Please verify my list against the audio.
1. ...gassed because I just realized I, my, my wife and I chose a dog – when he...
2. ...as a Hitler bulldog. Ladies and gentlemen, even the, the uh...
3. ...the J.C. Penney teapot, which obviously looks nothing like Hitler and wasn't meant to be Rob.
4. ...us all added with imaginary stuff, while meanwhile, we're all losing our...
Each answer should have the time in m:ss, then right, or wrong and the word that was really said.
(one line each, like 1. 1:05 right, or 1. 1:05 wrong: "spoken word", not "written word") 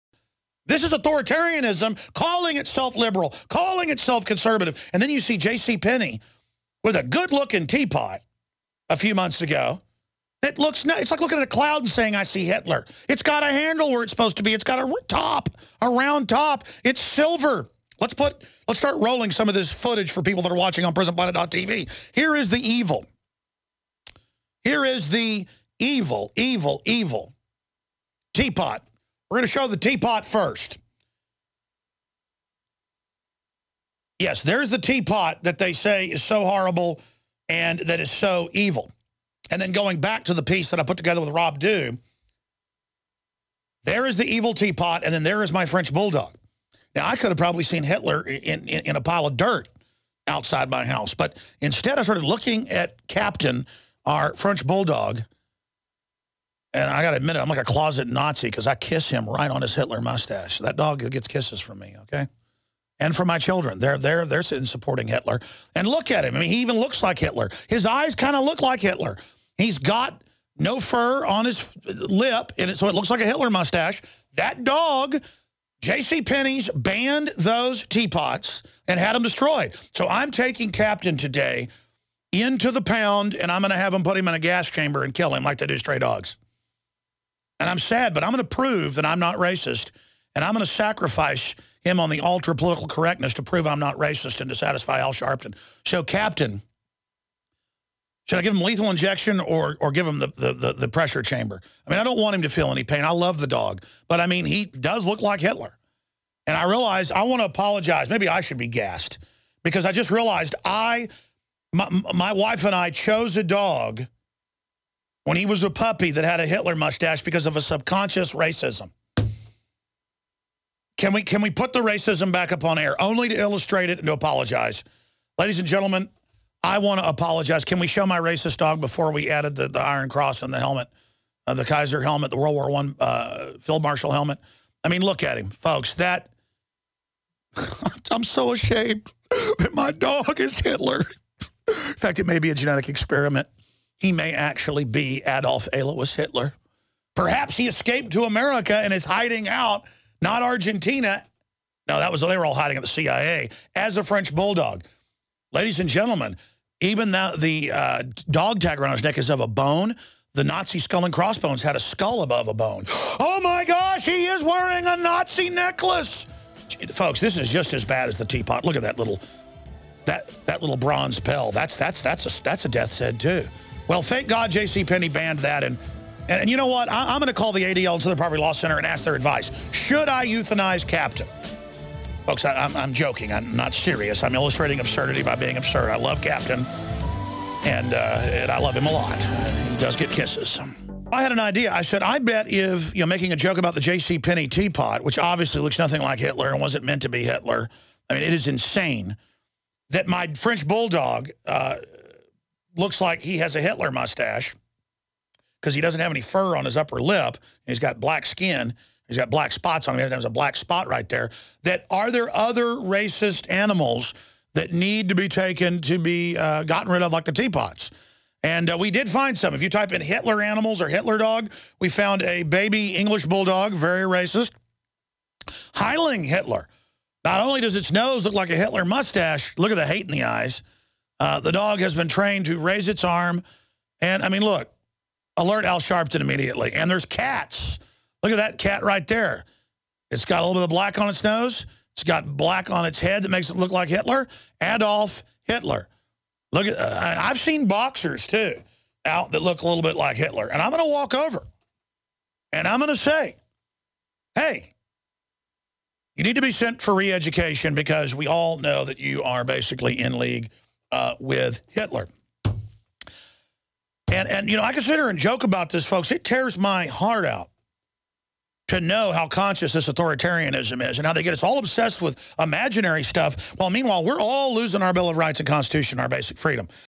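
1. 1:48 right
2. 2:33 wrong: "French", not "Hitler"
3. 3:13 wrong: "Hitler", not "Rob"
4. 4:31 wrong: "obsessed", not "added".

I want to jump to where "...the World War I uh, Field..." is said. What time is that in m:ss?
2:12.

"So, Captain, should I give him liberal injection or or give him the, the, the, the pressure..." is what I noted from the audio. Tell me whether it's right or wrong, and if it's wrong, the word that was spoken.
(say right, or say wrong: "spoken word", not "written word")
wrong: "lethal", not "liberal".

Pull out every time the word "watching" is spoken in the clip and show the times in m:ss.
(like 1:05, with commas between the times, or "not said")
0:20.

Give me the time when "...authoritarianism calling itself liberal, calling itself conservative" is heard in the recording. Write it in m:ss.
0:00.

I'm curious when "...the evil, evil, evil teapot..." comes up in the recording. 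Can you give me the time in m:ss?
0:25.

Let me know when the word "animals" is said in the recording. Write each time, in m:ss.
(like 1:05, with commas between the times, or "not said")
3:33, 3:40.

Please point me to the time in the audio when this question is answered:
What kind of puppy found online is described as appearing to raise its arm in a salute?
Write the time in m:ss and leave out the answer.
3:42.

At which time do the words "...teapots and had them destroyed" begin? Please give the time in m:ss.
1:17.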